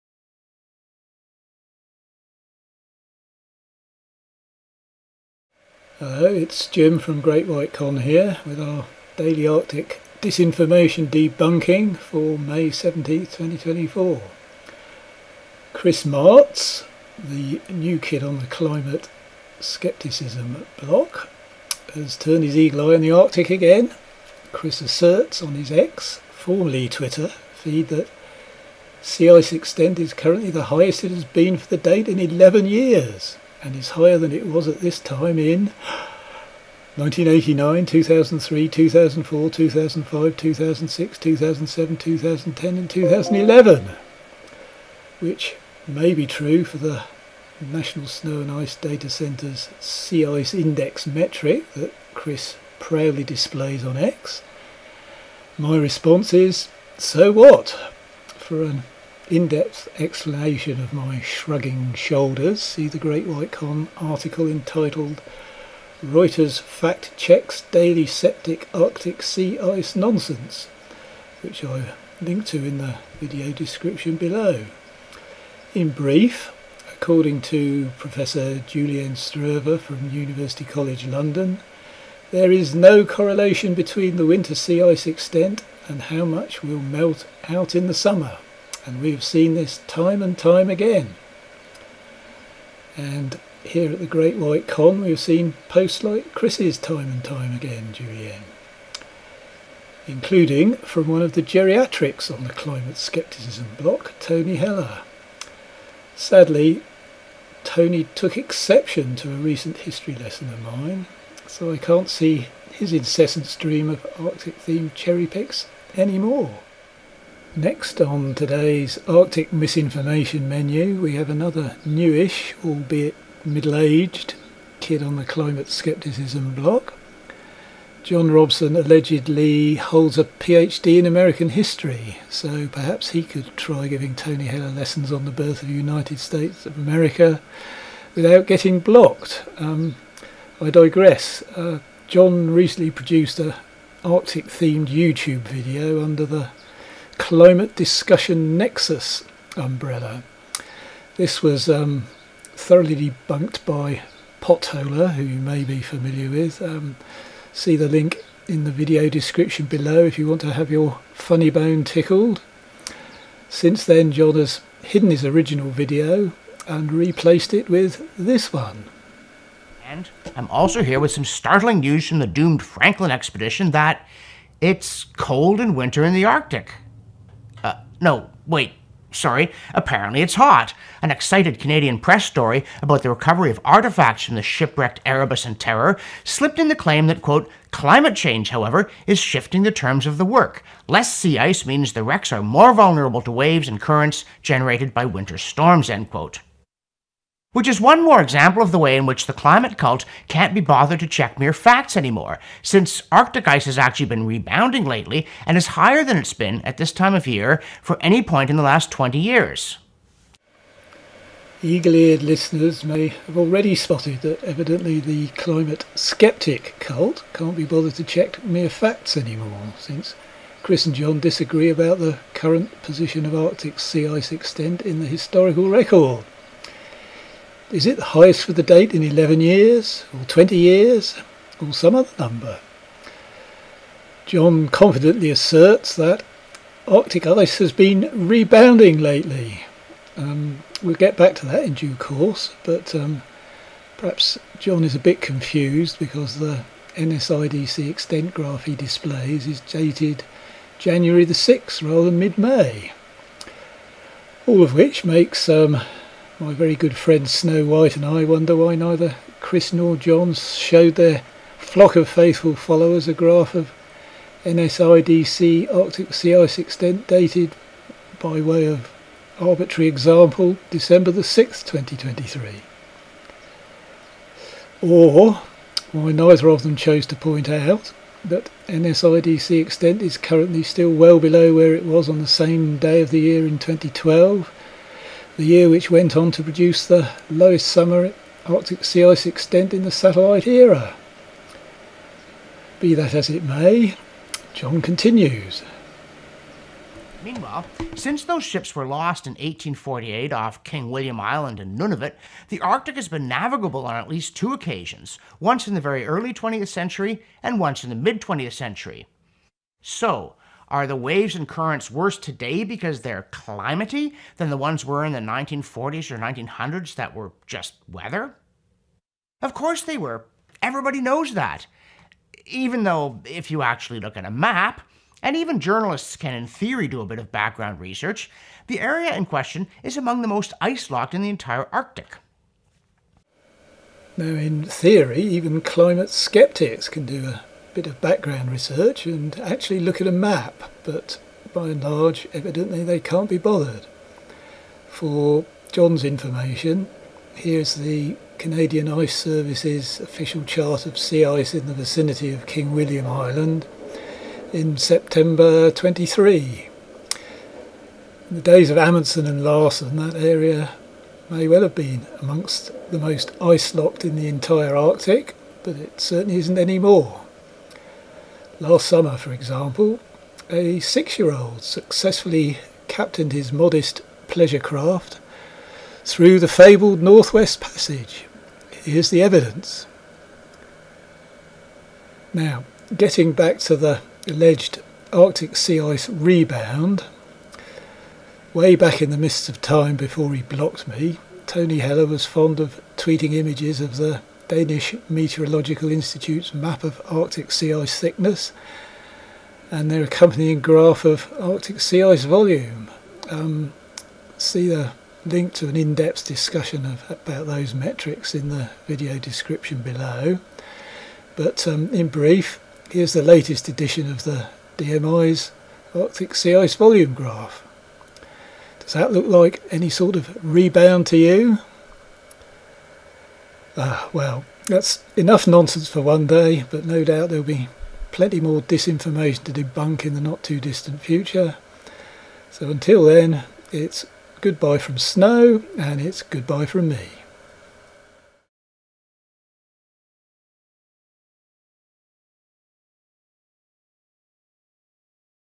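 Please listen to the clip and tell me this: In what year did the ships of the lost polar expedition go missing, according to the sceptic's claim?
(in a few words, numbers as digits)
1848.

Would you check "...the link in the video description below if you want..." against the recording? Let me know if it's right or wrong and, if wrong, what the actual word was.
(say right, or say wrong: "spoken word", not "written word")
right.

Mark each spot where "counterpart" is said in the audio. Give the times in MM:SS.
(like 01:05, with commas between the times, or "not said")
not said.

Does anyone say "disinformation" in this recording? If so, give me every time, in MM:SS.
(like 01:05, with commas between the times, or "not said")
00:10, 07:08.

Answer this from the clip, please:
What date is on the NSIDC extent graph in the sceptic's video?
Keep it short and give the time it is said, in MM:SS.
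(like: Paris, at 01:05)
January 6th, at 04:10.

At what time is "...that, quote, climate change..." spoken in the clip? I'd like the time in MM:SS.
03:07.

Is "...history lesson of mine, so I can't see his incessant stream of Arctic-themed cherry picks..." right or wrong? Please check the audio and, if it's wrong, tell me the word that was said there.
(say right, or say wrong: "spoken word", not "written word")
right.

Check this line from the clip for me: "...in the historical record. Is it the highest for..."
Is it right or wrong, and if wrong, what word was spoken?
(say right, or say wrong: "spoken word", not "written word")
right.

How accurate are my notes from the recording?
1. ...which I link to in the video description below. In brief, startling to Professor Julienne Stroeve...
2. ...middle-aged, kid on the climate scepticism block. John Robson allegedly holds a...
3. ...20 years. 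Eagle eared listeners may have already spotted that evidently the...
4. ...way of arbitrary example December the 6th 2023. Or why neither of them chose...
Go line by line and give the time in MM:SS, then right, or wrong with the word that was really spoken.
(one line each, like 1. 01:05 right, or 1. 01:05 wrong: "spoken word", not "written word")
1. 01:11 wrong: "according", not "startling"
2. 02:03 right
3. 03:28 right
4. 04:28 right.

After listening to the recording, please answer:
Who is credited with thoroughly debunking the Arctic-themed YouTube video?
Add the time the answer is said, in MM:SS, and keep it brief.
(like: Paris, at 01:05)
Potholer, at 02:34.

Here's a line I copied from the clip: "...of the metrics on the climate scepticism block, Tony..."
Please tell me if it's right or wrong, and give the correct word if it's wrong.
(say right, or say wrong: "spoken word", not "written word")
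wrong: "geriatrics", not "metrics".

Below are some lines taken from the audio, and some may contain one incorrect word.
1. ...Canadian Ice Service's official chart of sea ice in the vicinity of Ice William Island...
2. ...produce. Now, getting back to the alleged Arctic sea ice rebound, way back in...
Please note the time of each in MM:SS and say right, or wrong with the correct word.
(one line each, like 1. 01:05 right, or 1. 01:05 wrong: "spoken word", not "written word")
1. 05:48 wrong: "King", not "Ice"
2. 06:19 wrong: "evidence", not "produce".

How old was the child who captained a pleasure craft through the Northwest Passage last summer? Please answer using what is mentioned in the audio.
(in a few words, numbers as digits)
6.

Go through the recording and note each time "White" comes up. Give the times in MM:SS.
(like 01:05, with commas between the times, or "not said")
00:07, 01:03, 01:34, 04:17.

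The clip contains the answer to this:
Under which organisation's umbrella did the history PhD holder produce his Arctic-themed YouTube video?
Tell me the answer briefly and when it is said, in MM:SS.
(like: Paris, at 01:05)
Climate Discussion Nexus, at 02:27.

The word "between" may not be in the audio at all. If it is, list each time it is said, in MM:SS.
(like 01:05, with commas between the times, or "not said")
01:23.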